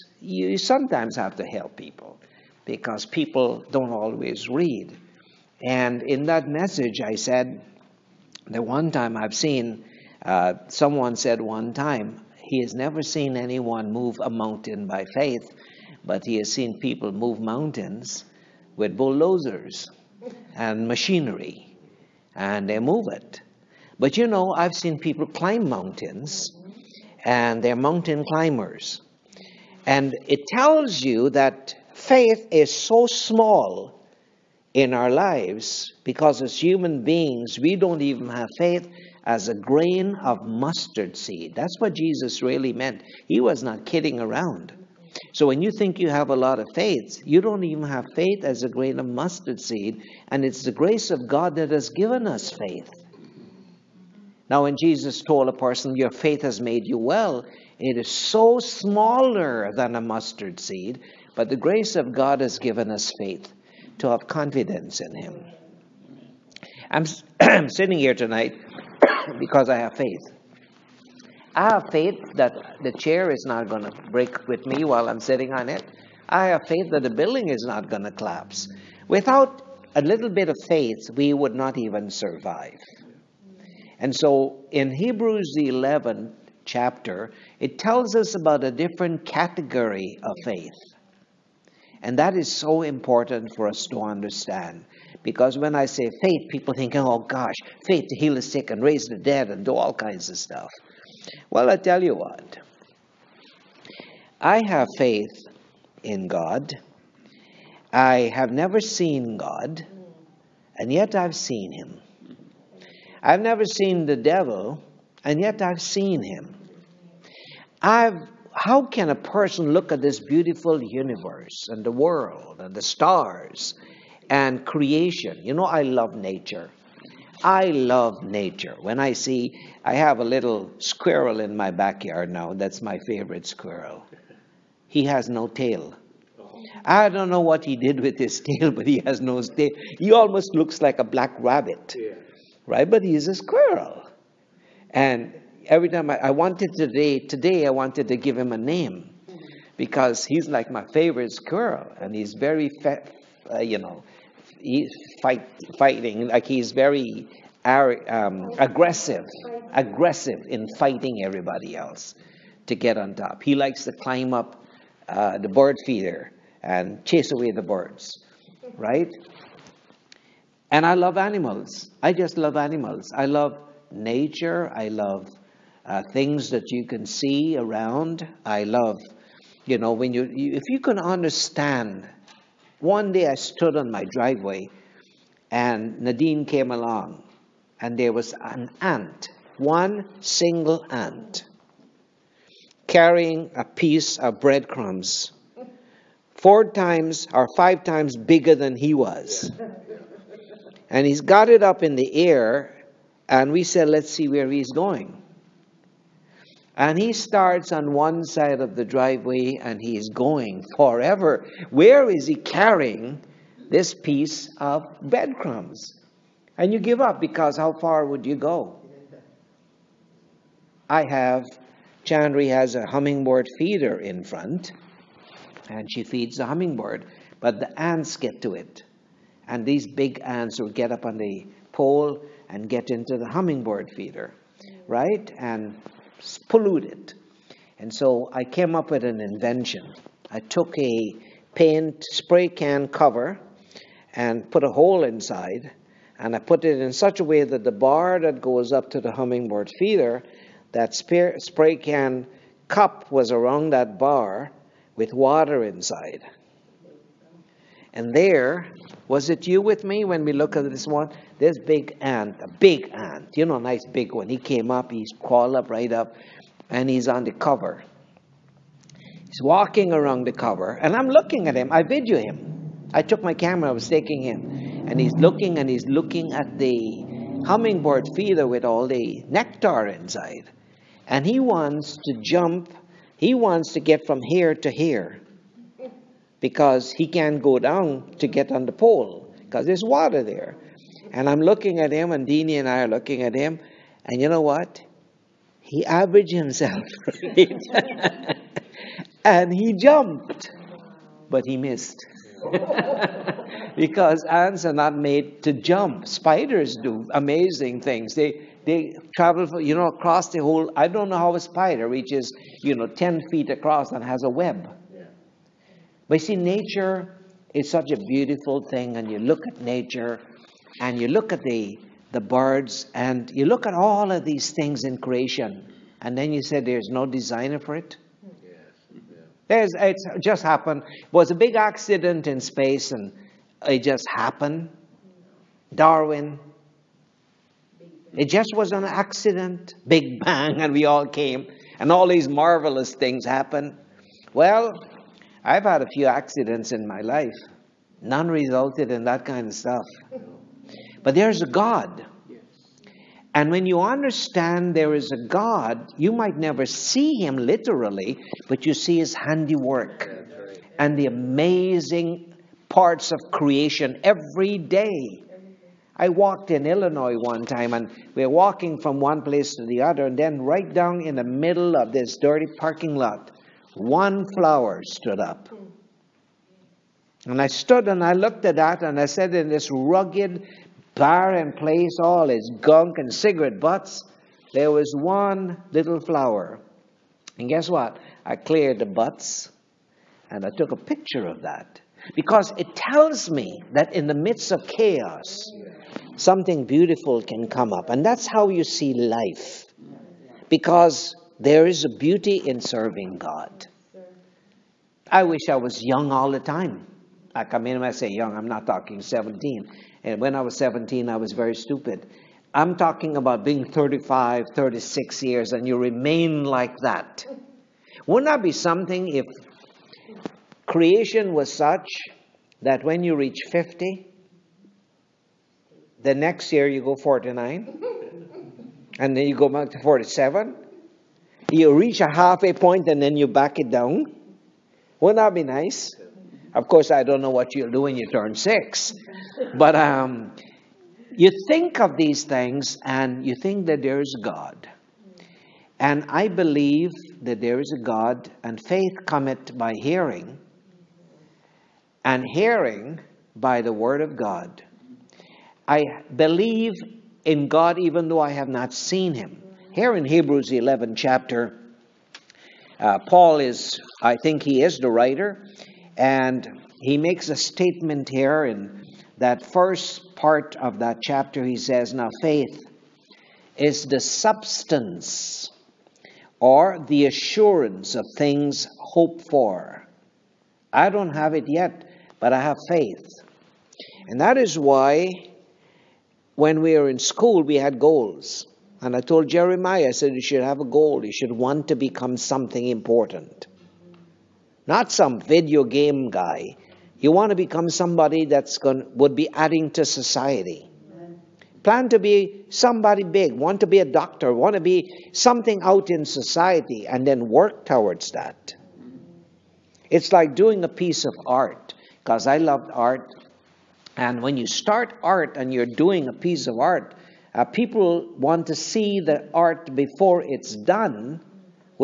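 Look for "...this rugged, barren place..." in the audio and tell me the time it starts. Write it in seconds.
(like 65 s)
379 s.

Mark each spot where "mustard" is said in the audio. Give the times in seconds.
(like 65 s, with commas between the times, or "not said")
40 s, 49 s, 60 s.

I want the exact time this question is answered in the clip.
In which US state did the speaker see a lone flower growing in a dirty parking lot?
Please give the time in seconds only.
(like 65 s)
366 s.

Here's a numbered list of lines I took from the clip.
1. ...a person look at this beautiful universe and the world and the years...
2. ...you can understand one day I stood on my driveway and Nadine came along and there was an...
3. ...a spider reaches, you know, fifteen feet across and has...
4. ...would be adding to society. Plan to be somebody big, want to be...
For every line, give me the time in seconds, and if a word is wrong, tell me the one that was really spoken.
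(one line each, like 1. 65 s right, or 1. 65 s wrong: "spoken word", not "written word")
1. 119 s wrong: "stars", not "years"
2. 180 s right
3. 311 s wrong: "ten", not "fifteen"
4. 498 s right.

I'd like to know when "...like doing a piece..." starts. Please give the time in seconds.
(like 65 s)
510 s.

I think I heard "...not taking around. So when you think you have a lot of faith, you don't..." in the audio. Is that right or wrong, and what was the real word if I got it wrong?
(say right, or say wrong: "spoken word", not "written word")
wrong: "kidding", not "taking".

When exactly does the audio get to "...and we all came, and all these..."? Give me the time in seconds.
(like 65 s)
340 s.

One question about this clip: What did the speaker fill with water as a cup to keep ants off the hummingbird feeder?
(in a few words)
Paint spray can cover.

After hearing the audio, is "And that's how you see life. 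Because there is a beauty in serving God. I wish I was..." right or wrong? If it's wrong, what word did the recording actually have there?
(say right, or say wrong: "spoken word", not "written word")
right.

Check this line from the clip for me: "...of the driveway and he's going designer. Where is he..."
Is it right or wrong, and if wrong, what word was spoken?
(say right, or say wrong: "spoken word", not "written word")
wrong: "forever", not "designer".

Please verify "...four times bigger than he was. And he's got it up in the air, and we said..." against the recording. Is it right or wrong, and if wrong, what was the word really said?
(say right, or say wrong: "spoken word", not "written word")
wrong: "five", not "four".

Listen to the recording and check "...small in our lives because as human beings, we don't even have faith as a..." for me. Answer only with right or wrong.
right.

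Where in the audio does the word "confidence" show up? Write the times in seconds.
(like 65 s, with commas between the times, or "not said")
64 s.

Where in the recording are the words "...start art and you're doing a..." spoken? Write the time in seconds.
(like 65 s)
514 s.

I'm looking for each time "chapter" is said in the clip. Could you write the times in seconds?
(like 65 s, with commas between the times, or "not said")
86 s, 460 s, 471 s.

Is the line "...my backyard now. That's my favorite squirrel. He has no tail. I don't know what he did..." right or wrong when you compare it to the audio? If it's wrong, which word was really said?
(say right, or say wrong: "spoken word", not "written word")
right.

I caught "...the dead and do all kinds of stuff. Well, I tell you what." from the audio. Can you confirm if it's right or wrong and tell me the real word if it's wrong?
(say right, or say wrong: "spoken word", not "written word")
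right.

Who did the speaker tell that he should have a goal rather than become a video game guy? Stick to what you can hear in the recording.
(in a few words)
Jeremiah.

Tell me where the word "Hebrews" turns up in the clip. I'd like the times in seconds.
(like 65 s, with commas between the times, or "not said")
84 s, 460 s.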